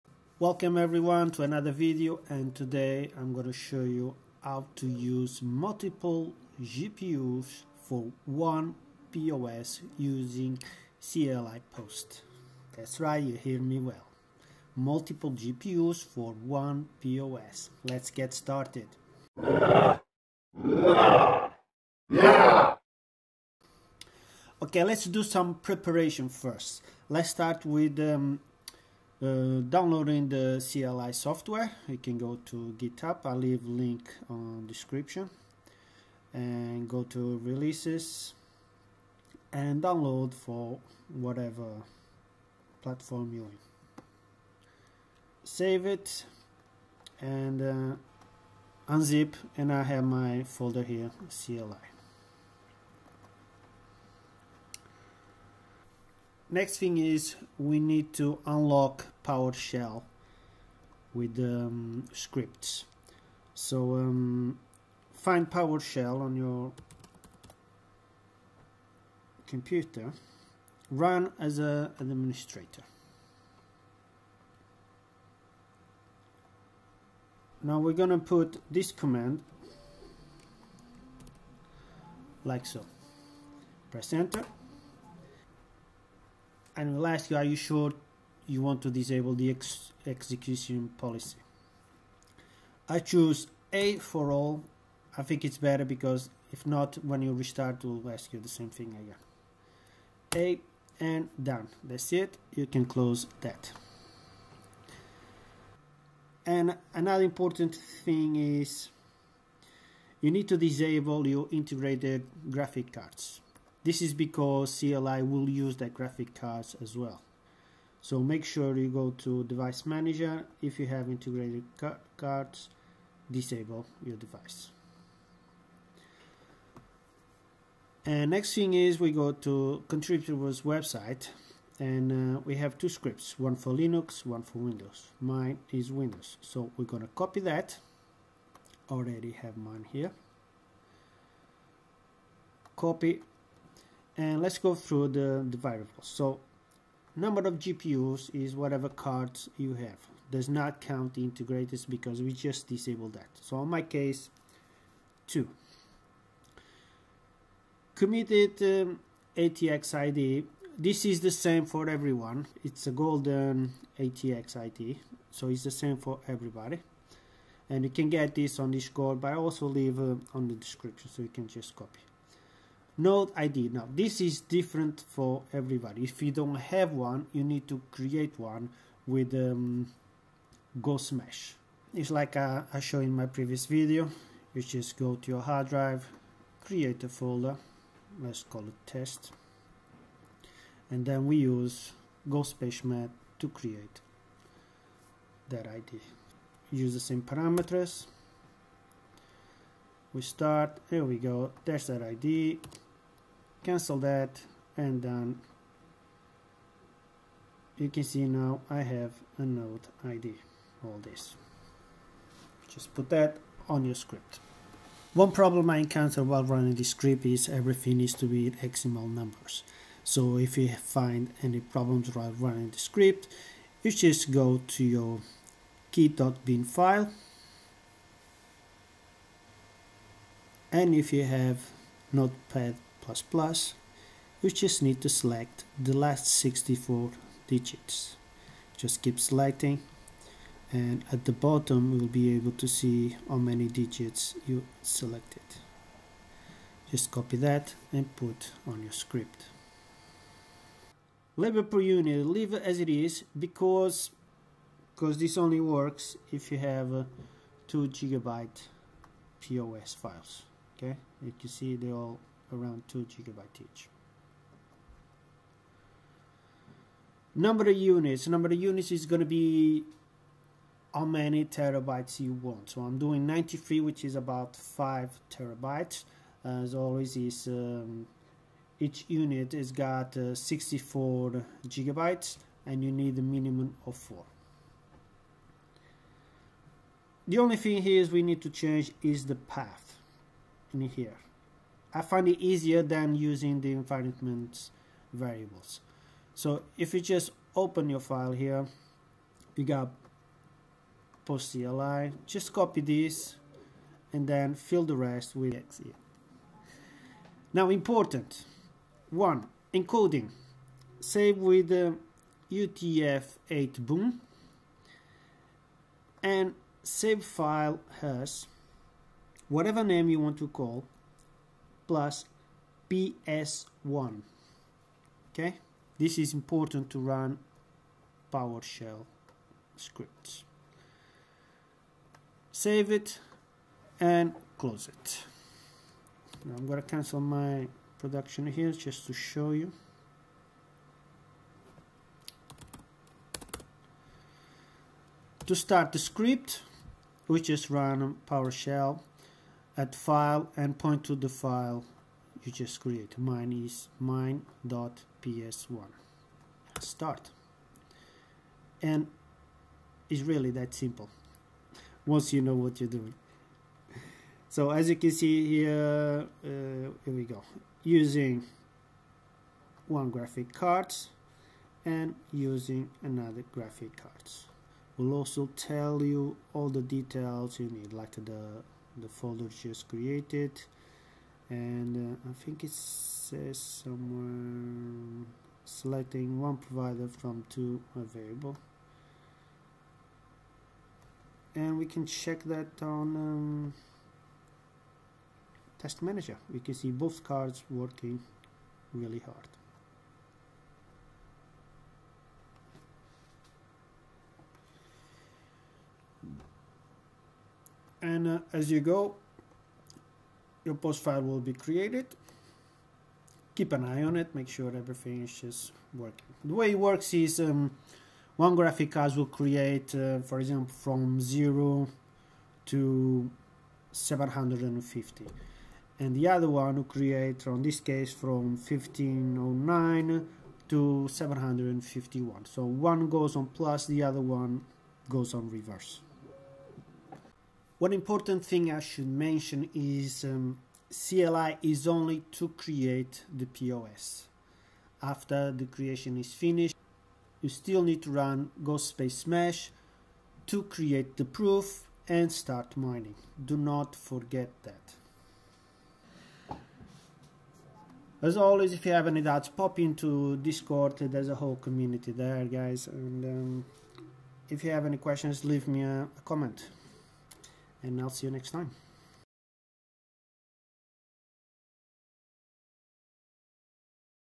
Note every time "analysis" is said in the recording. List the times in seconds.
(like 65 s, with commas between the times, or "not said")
not said.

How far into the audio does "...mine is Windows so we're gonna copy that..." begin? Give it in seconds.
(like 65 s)
135 s.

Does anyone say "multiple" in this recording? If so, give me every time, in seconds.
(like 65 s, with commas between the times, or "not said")
5 s, 14 s.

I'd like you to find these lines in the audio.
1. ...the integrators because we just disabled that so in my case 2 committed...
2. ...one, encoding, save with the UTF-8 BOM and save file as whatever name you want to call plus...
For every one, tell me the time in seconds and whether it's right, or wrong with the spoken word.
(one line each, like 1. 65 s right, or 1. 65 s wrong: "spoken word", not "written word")
1. 151 s right
2. 309 s right.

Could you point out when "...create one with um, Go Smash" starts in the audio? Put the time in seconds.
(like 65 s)
177 s.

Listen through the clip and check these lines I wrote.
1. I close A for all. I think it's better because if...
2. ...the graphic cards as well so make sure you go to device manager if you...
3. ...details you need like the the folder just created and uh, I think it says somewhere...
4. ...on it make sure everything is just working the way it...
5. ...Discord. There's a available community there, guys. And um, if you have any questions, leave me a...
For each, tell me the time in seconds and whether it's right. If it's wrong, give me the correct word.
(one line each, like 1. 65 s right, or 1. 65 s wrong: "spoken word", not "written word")
1. 92 s wrong: "choose", not "close"
2. 115 s right
3. 376 s right
4. 414 s right
5. 460 s wrong: "whole", not "available".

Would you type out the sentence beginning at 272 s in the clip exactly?
So I'm doing 93, which is about 5 terabytes.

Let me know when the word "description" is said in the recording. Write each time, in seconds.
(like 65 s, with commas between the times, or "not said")
34 s, 170 s.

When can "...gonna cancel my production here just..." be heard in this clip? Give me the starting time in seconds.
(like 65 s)
336 s.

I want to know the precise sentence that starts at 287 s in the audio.
The only thing here is we need to change is the path in here.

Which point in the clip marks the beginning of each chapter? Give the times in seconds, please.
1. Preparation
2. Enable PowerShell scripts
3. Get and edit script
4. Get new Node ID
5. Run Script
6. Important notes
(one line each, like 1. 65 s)
1. 25 s
2. 84 s
3. 130 s
4. 190 s
5. 350 s
6. 439 s.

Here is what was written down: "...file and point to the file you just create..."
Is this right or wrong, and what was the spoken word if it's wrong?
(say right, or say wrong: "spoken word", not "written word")
right.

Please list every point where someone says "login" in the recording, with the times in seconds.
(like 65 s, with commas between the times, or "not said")
not said.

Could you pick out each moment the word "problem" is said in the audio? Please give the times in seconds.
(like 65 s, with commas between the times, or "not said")
215 s, 221 s.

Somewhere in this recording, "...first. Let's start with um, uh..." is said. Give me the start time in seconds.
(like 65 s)
26 s.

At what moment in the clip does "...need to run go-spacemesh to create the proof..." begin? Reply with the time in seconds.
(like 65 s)
447 s.